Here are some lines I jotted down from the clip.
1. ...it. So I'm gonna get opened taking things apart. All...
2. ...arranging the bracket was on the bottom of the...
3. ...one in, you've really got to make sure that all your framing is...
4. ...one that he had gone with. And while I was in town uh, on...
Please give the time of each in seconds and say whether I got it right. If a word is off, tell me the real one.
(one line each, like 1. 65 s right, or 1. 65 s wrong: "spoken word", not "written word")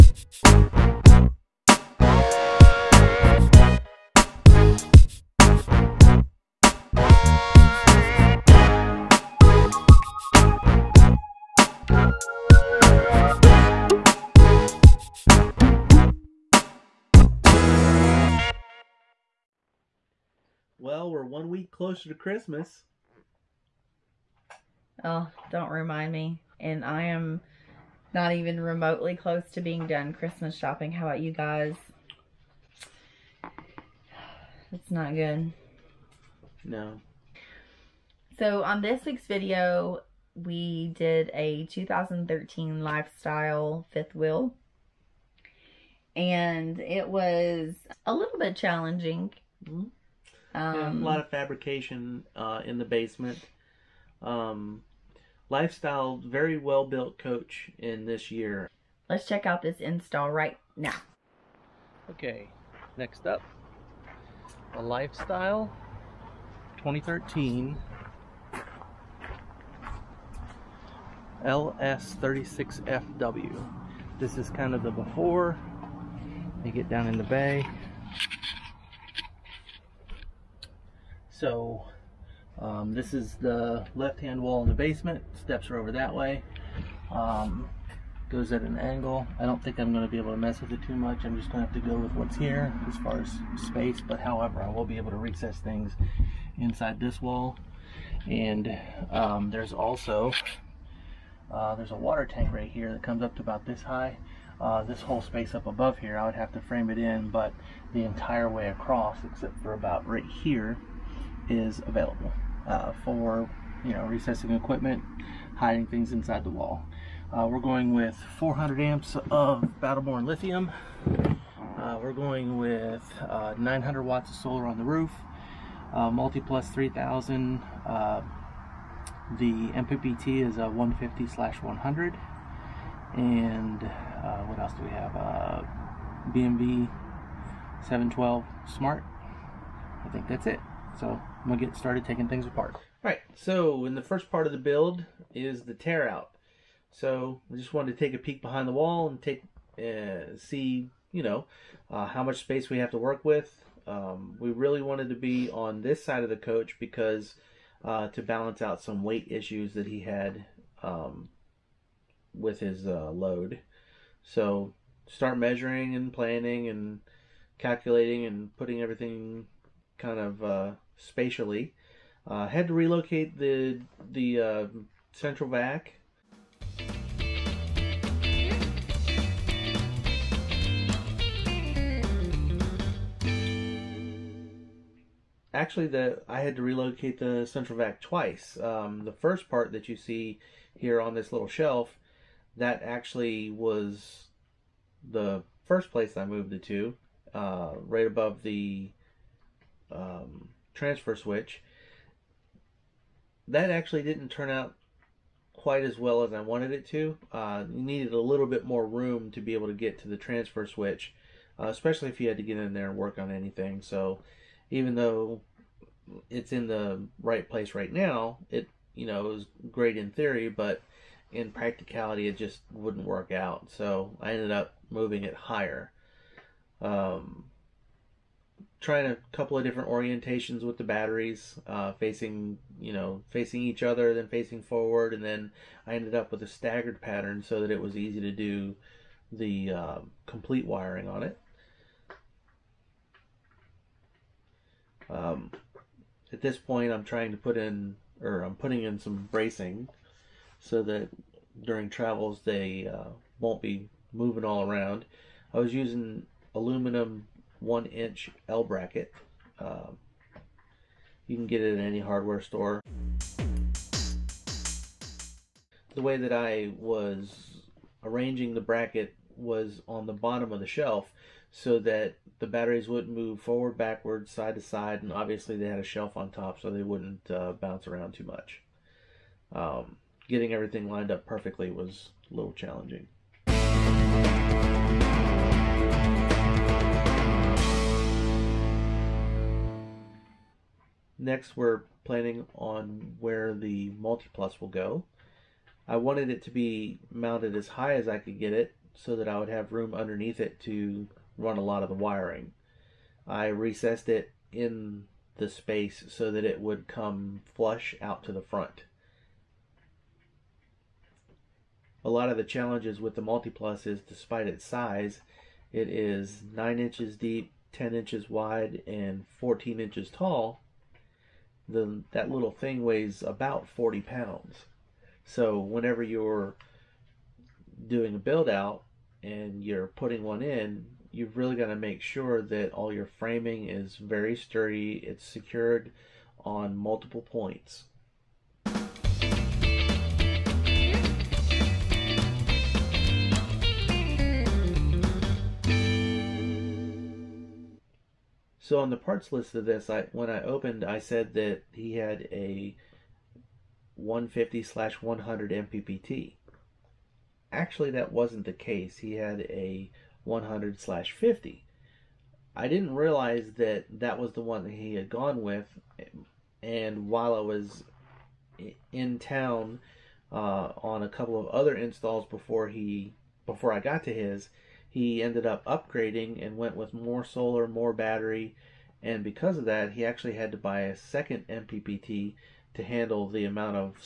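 1. 140 s wrong: "started", not "opened"
2. 268 s right
3. 330 s right
4. 364 s right.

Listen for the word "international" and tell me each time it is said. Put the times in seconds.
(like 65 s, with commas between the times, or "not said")
not said.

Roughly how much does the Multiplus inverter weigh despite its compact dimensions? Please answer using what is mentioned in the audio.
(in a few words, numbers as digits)
40 pounds.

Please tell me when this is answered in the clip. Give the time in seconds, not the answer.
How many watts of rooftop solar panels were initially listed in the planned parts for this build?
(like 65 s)
123 s.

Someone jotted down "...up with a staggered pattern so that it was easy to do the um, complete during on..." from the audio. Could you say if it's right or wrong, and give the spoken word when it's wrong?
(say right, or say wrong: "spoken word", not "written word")
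wrong: "wiring", not "during".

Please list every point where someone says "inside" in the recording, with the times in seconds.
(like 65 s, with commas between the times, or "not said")
96 s, 116 s.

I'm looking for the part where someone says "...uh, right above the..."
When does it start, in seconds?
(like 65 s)
197 s.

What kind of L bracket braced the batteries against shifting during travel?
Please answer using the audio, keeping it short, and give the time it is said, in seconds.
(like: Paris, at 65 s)
aluminum one inch, at 256 s.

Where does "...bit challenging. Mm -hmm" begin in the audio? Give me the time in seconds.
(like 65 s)
48 s.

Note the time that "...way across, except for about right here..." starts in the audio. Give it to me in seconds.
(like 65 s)
108 s.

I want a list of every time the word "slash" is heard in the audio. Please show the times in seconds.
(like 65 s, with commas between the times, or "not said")
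131 s, 354 s, 360 s.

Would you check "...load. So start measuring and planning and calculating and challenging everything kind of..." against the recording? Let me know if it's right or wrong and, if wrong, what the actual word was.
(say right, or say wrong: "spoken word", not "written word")
wrong: "putting", not "challenging".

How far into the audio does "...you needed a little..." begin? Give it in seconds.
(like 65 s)
207 s.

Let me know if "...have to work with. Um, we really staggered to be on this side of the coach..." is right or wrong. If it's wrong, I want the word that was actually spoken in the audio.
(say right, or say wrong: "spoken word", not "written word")
wrong: "wanted", not "staggered".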